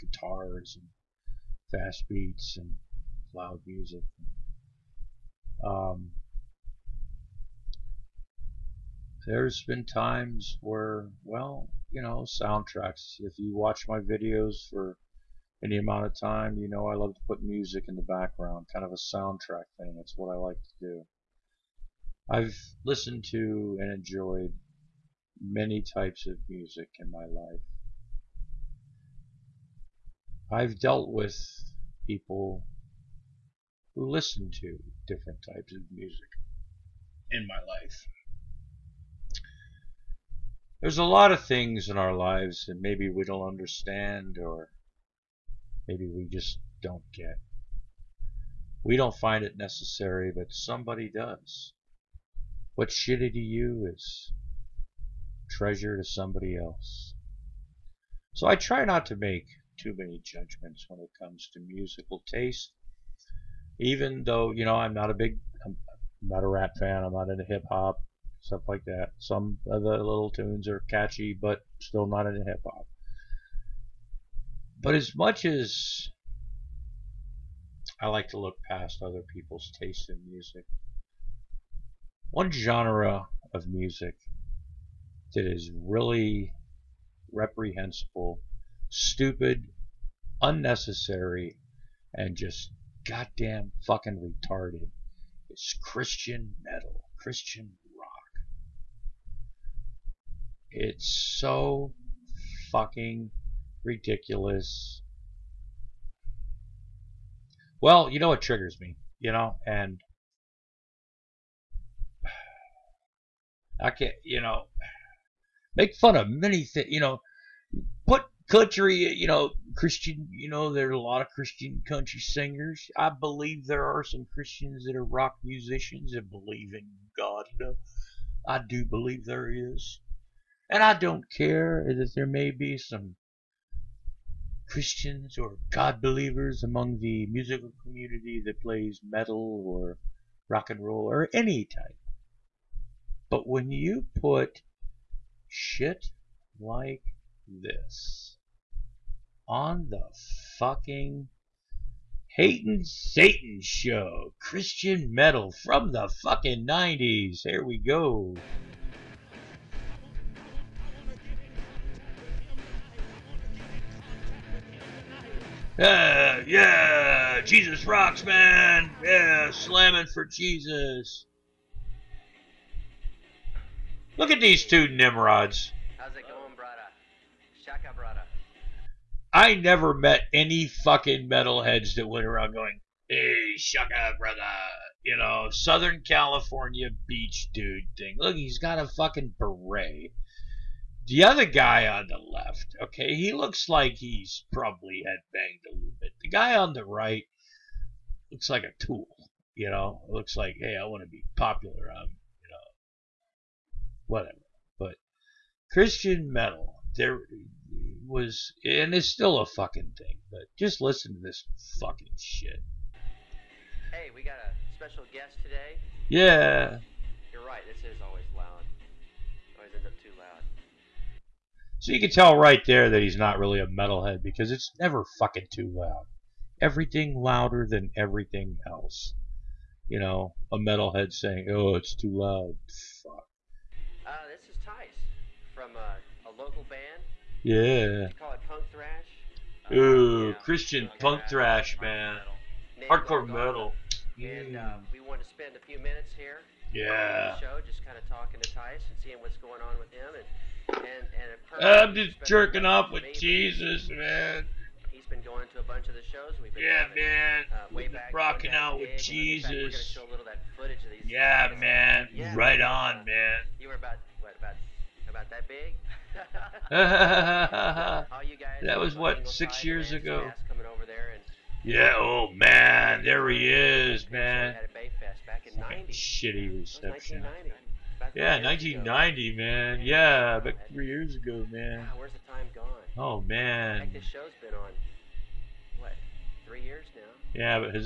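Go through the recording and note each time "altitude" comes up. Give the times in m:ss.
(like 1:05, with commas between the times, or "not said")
not said.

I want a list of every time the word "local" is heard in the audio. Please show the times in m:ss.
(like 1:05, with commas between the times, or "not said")
3:56.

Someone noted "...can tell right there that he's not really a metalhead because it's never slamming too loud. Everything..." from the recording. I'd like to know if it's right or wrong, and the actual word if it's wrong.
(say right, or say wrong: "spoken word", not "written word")
wrong: "fucking", not "slamming".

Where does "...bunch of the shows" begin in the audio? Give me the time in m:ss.
4:15.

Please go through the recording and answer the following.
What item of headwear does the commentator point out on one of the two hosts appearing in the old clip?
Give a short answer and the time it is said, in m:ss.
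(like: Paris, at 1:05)
beret, at 3:09.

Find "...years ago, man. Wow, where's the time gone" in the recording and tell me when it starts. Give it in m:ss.
4:40.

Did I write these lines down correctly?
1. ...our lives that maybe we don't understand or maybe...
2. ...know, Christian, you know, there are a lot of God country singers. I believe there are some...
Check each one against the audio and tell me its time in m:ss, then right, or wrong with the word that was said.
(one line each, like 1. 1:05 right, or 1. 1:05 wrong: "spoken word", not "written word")
1. 0:41 right
2. 1:59 wrong: "Christian", not "God".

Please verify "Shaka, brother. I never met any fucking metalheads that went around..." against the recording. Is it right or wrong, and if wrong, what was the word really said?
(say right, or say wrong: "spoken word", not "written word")
right.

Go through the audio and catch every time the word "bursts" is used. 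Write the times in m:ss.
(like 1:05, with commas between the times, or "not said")
not said.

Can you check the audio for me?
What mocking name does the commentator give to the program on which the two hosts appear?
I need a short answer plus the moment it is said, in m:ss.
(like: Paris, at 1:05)
Hating Satan show, at 2:32.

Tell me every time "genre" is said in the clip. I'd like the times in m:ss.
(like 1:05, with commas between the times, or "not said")
1:22.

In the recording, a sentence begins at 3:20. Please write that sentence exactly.
It looks like, hey, I want to be popular.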